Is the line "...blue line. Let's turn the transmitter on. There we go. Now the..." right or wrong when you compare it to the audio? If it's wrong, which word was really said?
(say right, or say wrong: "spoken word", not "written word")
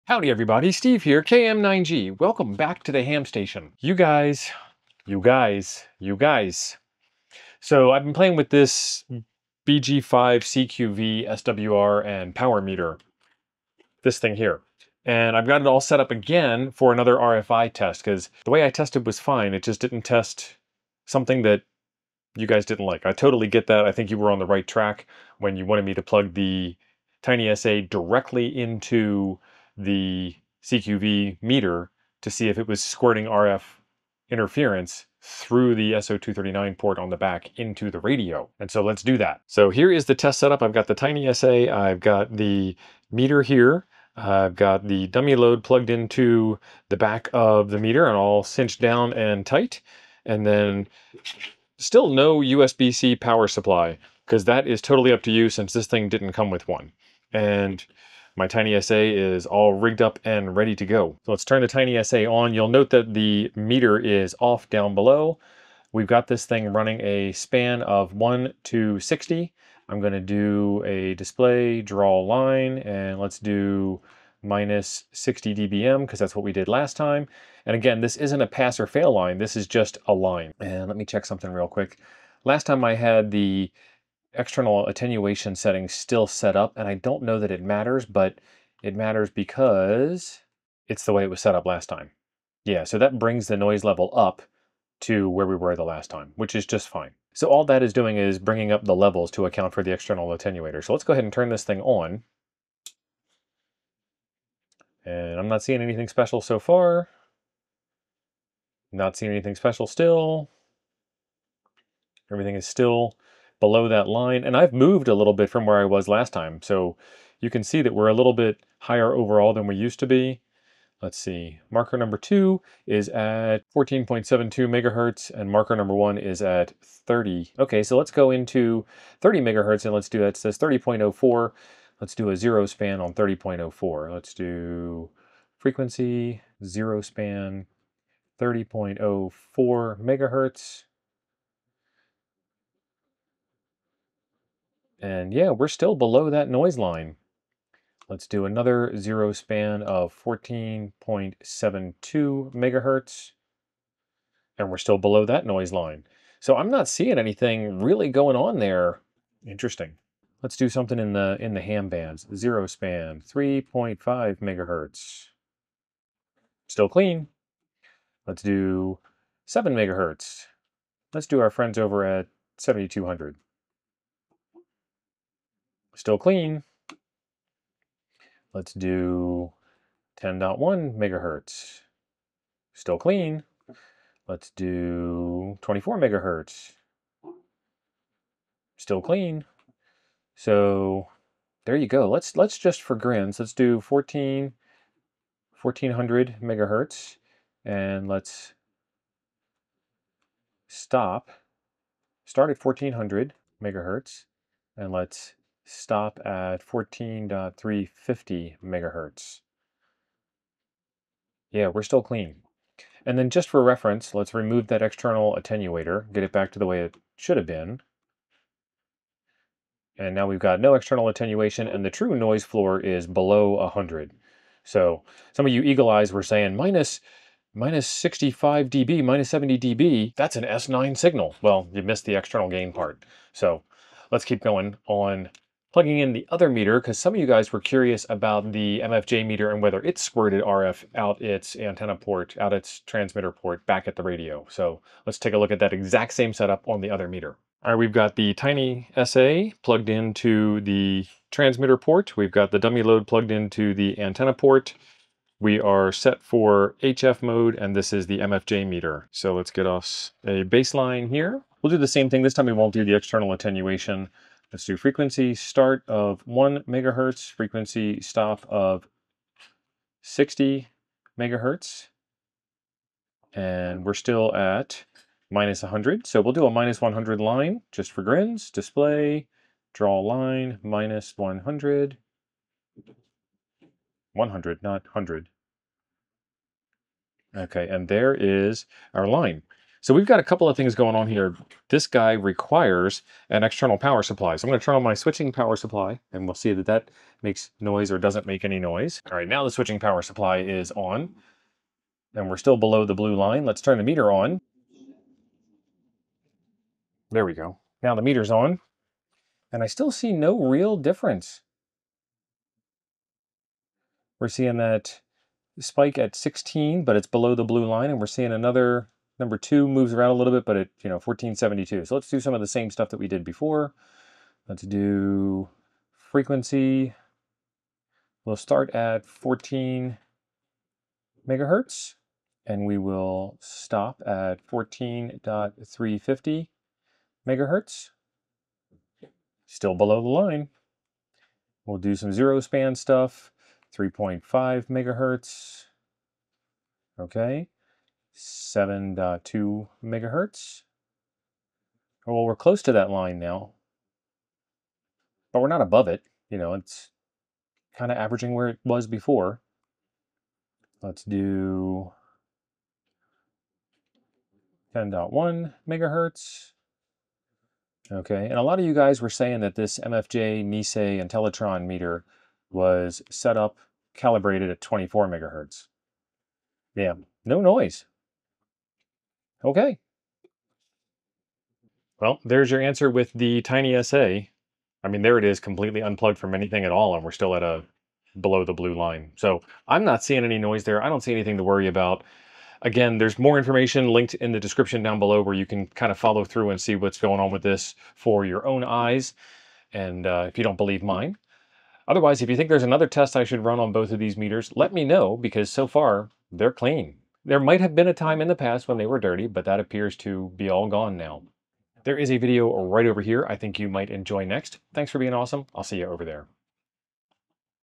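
wrong: "meter", not "transmitter".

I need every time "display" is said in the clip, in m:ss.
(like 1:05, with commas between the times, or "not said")
1:11, 4:38.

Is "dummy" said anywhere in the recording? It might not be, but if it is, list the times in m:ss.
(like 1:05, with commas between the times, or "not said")
0:45, 4:12.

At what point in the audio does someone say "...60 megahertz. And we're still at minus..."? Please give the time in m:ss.
4:30.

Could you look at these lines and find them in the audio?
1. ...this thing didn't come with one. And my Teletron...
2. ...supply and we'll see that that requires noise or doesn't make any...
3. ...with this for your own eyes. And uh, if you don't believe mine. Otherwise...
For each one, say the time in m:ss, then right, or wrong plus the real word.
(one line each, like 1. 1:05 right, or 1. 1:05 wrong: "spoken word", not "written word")
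1. 0:55 wrong: "TinySA", not "Teletron"
2. 4:55 wrong: "makes", not "requires"
3. 6:37 right.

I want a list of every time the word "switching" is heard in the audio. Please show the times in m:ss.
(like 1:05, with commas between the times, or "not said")
4:54, 4:59.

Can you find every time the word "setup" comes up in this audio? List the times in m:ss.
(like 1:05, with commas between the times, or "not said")
0:40, 4:06.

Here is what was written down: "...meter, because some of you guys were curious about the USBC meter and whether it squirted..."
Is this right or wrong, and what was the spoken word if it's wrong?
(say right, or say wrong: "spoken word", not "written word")
wrong: "MFJ", not "USBC".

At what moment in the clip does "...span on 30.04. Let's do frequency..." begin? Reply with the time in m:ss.
2:12.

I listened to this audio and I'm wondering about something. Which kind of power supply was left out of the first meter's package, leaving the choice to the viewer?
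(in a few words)
USB-C.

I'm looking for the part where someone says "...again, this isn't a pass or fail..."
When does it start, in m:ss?
1:17.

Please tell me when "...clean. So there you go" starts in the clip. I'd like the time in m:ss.
3:09.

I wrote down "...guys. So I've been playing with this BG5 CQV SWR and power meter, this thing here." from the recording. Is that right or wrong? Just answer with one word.
right.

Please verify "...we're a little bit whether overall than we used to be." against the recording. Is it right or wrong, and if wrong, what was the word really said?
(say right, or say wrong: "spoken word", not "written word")
wrong: "higher", not "whether".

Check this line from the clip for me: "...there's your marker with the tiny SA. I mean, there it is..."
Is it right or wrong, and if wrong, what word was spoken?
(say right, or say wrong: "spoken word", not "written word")
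wrong: "answer", not "marker".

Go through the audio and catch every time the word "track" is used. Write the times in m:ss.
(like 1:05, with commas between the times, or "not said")
0:24.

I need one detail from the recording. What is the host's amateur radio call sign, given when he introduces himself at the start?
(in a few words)
KM9G.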